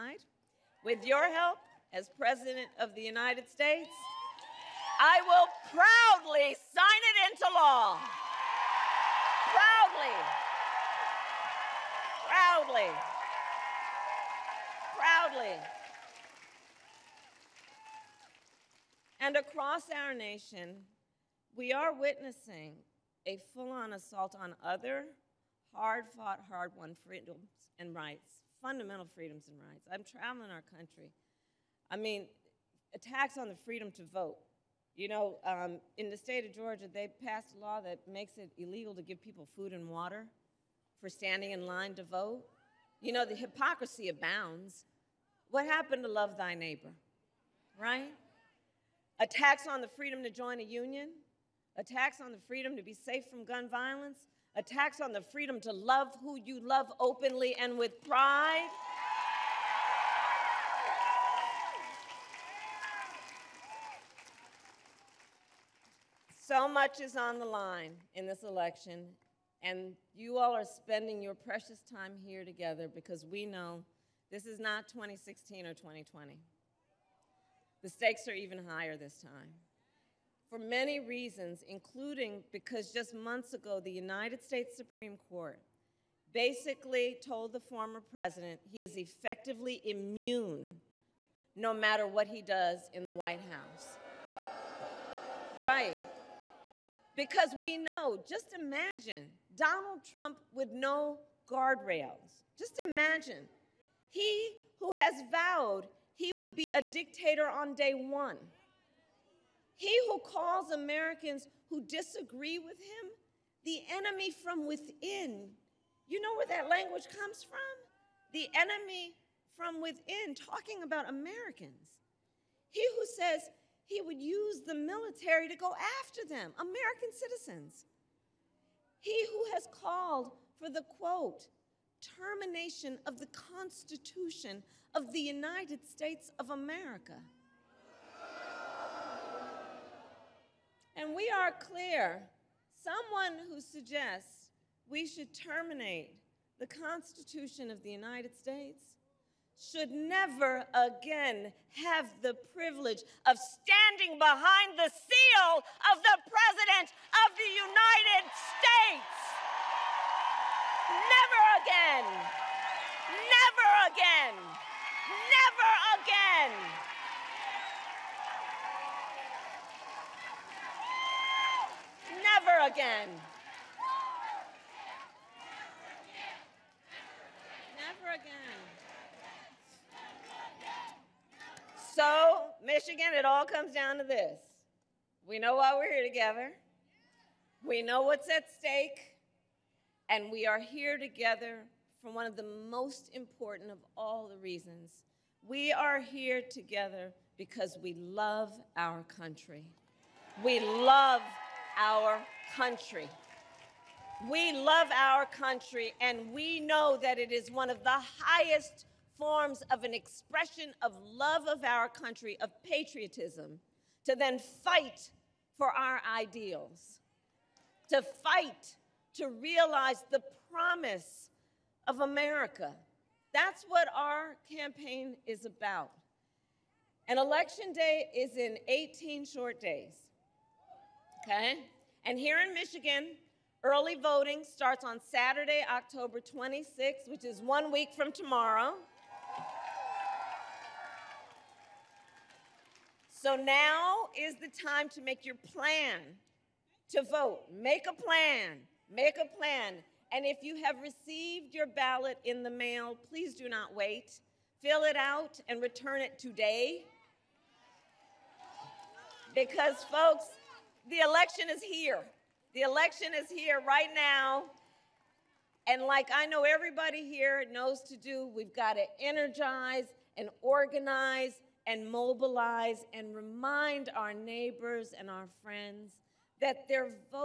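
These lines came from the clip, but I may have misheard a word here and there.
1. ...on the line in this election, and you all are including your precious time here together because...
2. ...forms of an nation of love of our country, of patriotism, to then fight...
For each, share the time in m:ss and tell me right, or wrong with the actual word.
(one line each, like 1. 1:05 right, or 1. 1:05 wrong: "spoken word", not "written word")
1. 1:07 wrong: "spending", not "including"
2. 3:29 wrong: "expression", not "nation".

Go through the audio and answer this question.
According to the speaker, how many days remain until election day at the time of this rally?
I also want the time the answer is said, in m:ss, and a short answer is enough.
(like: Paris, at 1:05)
18, at 3:48.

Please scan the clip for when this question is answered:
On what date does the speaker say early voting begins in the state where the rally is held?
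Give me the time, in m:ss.
3:55.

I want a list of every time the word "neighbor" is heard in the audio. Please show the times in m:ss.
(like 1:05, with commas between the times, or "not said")
0:46, 4:34.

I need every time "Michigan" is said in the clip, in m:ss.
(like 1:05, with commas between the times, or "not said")
3:02, 3:52.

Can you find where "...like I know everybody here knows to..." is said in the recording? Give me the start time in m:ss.
4:25.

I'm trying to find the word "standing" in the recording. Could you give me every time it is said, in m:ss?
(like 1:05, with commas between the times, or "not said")
0:41, 2:33.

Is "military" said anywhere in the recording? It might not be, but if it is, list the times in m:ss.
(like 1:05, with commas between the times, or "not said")
2:04.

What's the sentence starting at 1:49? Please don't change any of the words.
He who calls Americans who disagree with him the enemy from within.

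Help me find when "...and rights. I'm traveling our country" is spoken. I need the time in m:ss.
0:29.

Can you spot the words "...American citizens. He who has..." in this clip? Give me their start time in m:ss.
2:06.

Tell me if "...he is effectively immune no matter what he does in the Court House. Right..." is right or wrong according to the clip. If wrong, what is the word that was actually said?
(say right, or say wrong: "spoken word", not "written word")
wrong: "White", not "Court".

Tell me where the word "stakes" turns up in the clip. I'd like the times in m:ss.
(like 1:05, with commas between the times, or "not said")
1:17, 3:08.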